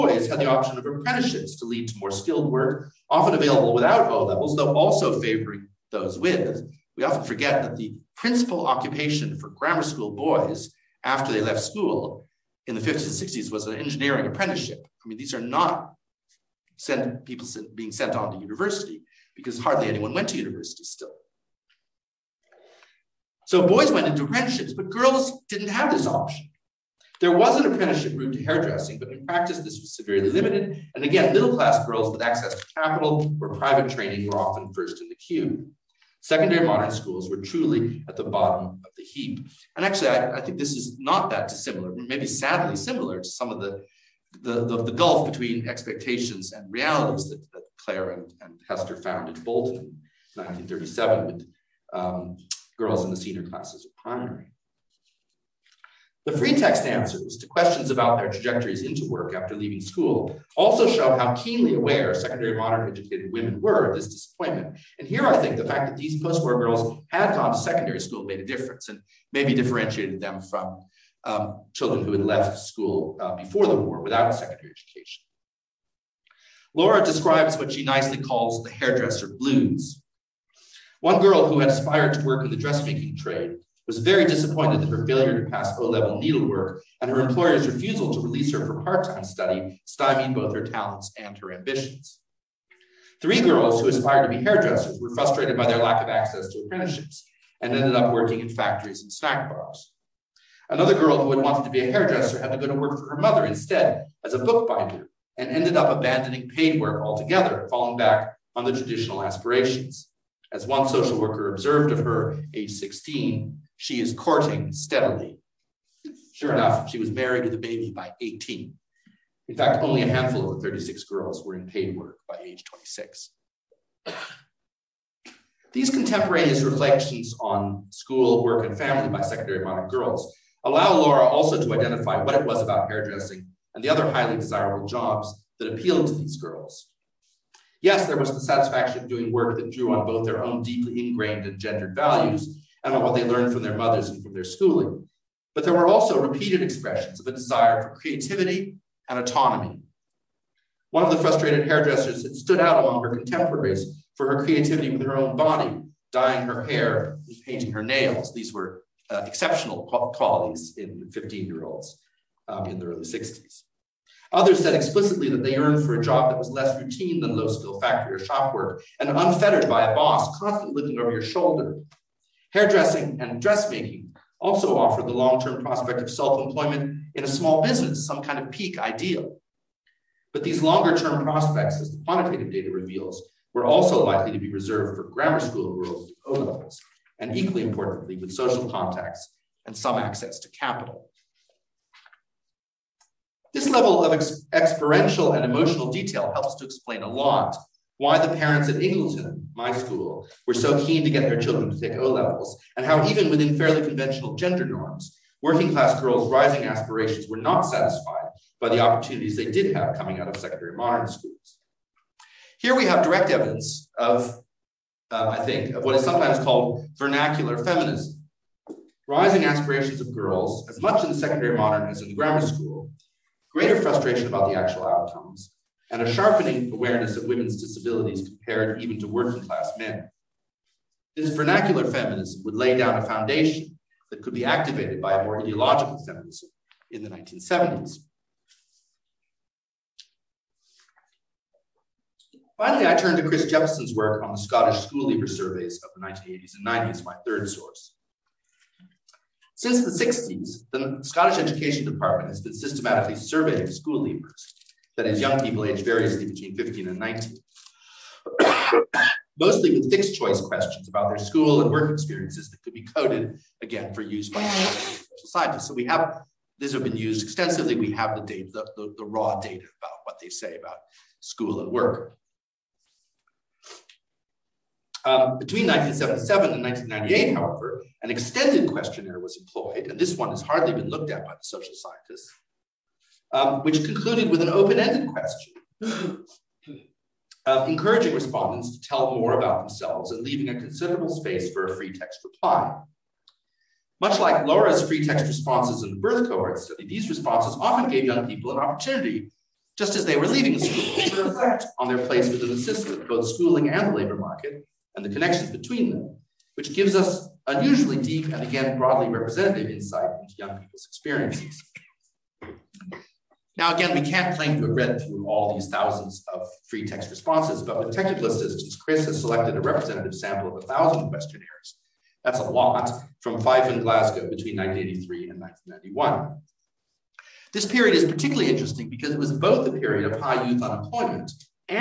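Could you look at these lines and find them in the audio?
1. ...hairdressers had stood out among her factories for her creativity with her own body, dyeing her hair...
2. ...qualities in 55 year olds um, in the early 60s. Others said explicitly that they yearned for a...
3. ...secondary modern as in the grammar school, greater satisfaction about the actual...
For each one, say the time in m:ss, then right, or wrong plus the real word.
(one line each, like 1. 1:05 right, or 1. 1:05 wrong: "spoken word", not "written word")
1. 2:31 wrong: "contemporaries", not "factories"
2. 2:40 wrong: "15", not "55"
3. 3:41 wrong: "frustration", not "satisfaction".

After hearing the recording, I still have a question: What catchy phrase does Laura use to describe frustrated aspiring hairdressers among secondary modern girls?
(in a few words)
hairdresser blues.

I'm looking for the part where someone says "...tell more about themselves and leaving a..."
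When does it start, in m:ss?
4:48.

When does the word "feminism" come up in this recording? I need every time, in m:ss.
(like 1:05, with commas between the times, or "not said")
3:37, 3:51, 3:56.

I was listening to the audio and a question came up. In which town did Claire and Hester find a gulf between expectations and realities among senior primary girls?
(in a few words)
Bolton.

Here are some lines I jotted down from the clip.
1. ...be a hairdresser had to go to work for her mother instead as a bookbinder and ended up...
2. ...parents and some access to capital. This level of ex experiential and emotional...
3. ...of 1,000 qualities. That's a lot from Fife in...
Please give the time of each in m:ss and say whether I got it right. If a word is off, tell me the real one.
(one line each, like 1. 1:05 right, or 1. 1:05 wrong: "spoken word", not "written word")
1. 1:41 right
2. 3:08 wrong: "contacts", not "parents"
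3. 5:20 wrong: "questionnaires", not "qualities".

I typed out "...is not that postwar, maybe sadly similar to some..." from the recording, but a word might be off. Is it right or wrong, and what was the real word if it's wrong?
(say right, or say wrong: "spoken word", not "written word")
wrong: "dissimilar", not "postwar".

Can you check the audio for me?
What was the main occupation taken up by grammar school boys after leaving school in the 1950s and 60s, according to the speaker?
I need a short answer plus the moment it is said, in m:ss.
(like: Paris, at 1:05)
engineering apprenticeship, at 0:13.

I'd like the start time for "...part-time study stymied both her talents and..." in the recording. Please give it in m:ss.
1:28.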